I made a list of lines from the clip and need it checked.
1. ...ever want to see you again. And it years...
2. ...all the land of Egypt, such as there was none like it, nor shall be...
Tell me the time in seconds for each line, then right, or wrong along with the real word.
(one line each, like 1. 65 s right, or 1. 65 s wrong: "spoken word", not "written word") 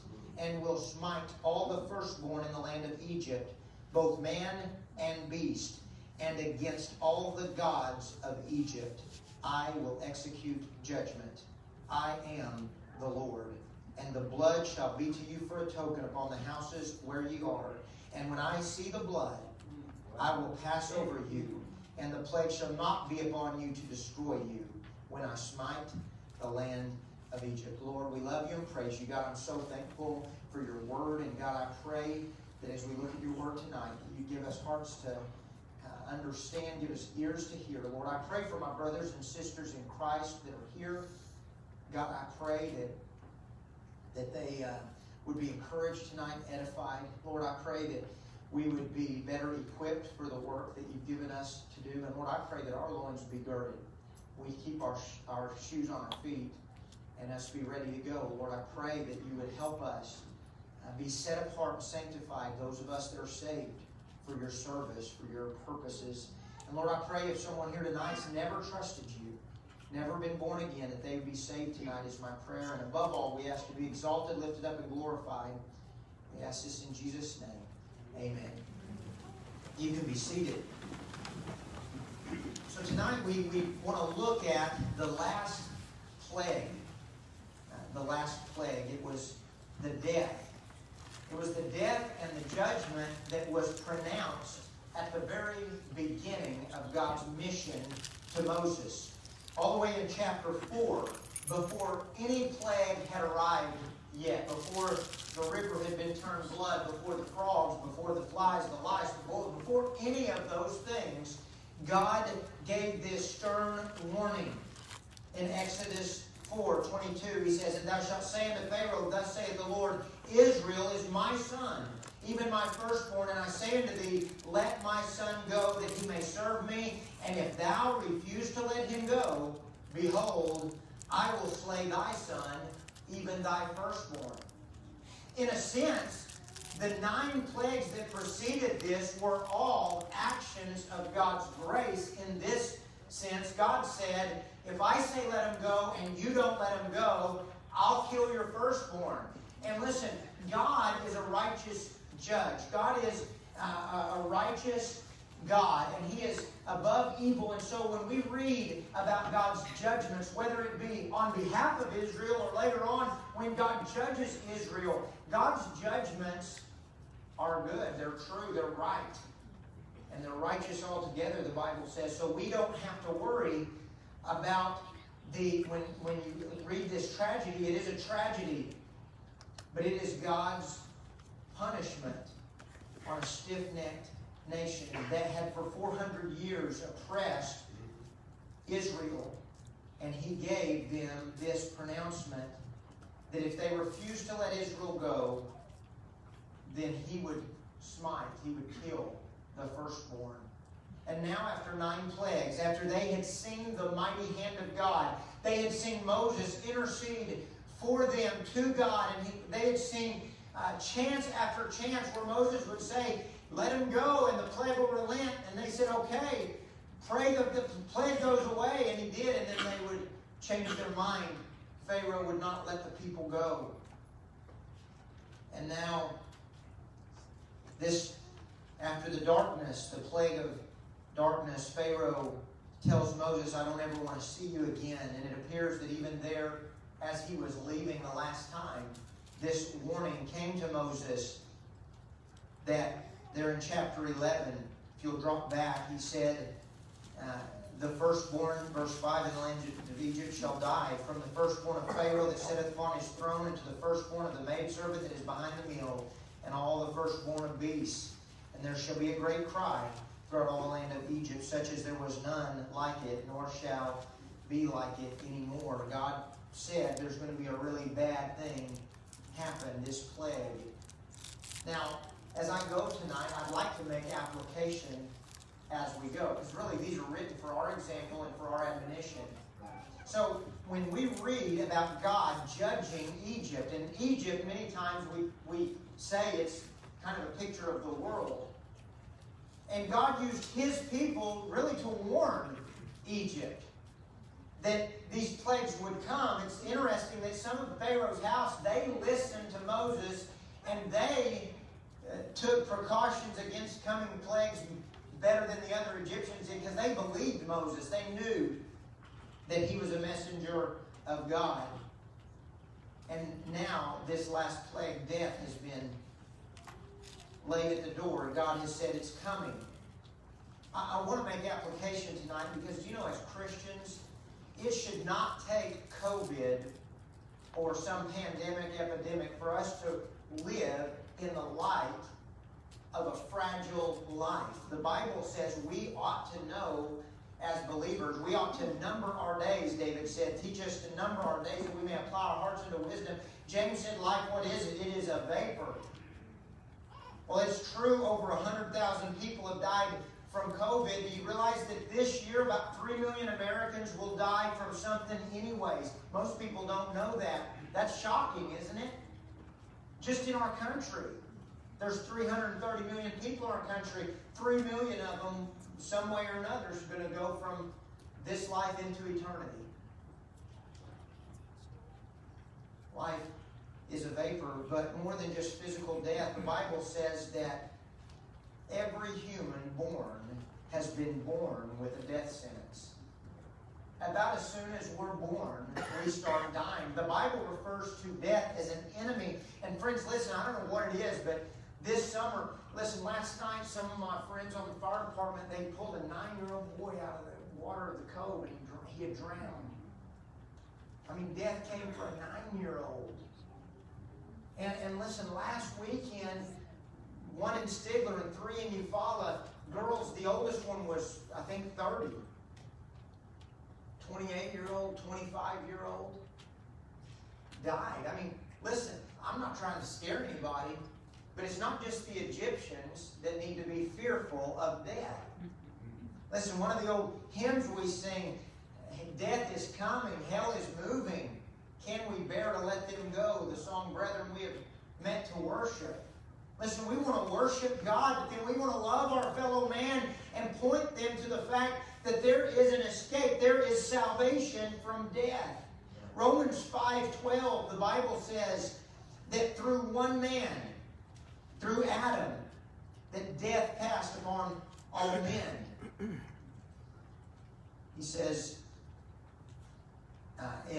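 1. 233 s wrong: "appears", not "years"
2. 260 s right.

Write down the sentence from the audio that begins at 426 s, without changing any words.
Listen, one of the old hymns we sing Death is coming, hell is moving.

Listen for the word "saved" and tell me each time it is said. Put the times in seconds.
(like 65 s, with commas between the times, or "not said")
63 s, 71 s.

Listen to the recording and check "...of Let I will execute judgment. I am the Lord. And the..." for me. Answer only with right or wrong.
wrong.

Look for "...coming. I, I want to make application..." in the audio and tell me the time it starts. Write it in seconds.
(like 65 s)
319 s.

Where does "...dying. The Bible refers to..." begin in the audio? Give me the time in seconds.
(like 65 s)
386 s.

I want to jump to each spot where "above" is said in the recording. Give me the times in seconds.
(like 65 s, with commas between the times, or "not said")
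72 s, 156 s.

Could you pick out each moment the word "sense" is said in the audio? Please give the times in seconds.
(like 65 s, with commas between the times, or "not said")
135 s, 143 s.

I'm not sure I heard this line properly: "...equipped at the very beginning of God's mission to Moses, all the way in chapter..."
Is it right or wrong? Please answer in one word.
wrong.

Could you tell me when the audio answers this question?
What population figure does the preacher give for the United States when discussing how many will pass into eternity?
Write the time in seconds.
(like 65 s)
362 s.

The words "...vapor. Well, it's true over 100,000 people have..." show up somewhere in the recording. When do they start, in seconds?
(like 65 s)
345 s.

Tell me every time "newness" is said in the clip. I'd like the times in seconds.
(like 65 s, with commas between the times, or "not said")
not said.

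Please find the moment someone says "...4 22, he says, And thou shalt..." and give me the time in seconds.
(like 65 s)
116 s.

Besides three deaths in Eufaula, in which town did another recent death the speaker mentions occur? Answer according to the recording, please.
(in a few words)
Stigler.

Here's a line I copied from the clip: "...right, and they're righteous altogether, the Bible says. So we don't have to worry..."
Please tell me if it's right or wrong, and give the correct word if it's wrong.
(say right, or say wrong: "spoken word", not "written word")
right.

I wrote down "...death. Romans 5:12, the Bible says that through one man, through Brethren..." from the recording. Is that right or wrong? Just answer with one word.
wrong.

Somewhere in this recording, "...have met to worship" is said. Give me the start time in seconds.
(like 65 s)
434 s.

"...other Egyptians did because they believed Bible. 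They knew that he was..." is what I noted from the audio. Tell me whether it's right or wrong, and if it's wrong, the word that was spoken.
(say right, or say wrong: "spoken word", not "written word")
wrong: "Moses", not "Bible".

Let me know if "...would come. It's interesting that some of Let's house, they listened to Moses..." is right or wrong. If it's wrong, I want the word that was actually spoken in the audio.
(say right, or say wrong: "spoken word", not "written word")
wrong: "Pharaoh", not "Let".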